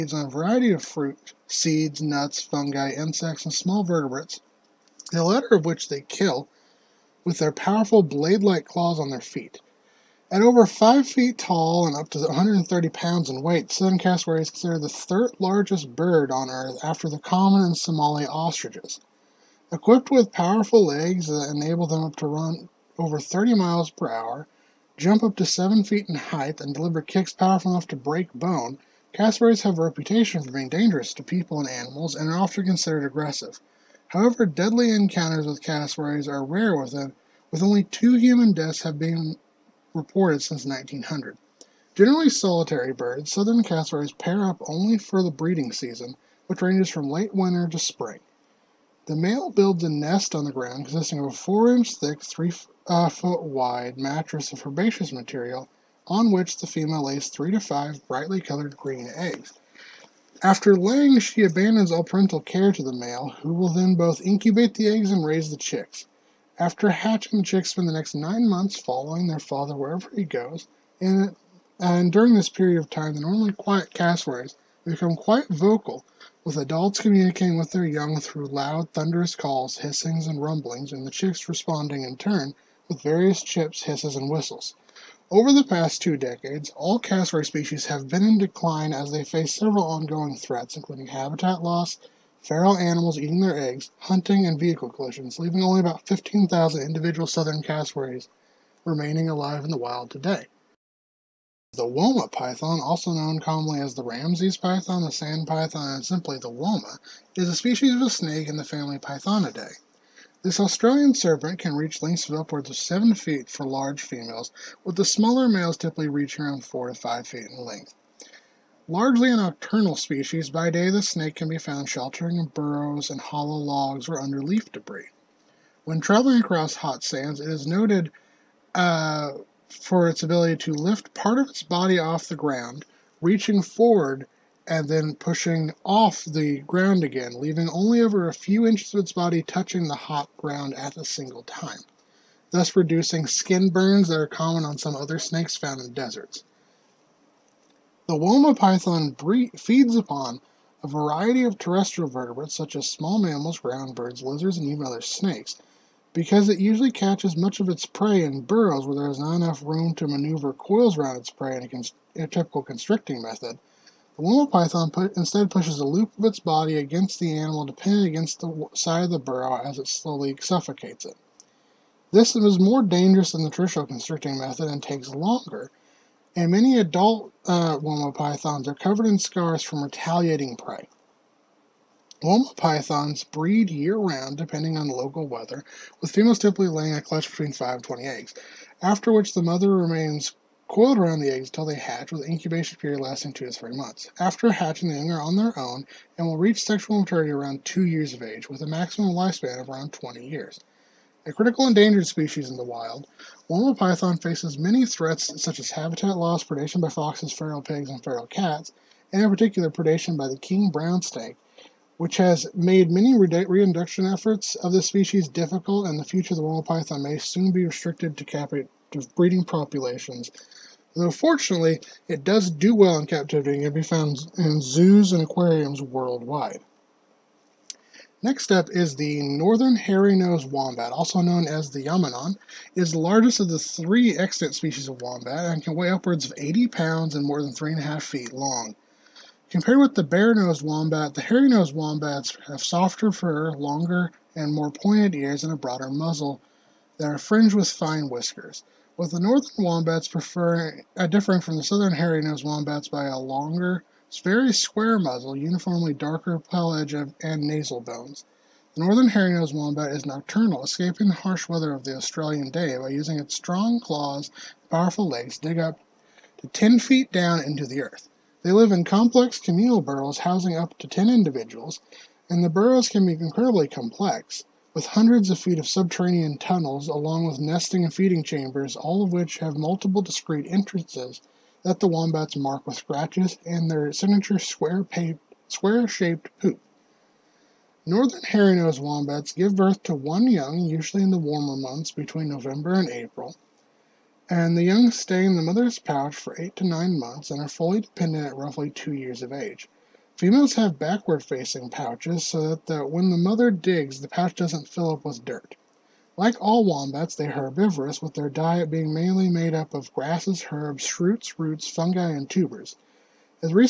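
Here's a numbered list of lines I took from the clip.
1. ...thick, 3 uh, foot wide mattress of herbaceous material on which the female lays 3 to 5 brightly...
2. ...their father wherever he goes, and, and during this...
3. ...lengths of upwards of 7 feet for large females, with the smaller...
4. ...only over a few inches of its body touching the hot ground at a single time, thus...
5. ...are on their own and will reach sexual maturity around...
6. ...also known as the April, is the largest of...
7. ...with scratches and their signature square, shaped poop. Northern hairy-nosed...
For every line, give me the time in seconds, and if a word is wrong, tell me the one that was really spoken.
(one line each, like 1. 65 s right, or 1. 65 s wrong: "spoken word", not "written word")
1. 51 s right
2. 69 s right
3. 111 s right
4. 137 s right
5. 195 s right
6. 230 s wrong: "Yaminon", not "April"
7. 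282 s right.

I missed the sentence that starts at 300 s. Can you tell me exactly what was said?
Females have backward facing pouches so that the, when the mother digs, the pouch doesn't fill up with dirt.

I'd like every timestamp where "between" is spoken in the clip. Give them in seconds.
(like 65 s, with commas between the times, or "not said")
187 s, 291 s.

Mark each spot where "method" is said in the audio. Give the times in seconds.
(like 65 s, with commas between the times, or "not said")
163 s, 174 s.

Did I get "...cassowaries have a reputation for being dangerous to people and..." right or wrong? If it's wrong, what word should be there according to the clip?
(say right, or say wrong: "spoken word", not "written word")
right.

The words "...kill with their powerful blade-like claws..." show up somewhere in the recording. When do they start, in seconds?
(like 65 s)
6 s.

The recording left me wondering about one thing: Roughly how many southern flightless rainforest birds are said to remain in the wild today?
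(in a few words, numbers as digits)
15,000.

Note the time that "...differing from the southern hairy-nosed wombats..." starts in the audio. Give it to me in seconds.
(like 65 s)
251 s.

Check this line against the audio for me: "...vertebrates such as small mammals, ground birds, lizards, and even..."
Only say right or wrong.
right.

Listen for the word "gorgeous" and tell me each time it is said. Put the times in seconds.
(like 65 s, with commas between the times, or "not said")
not said.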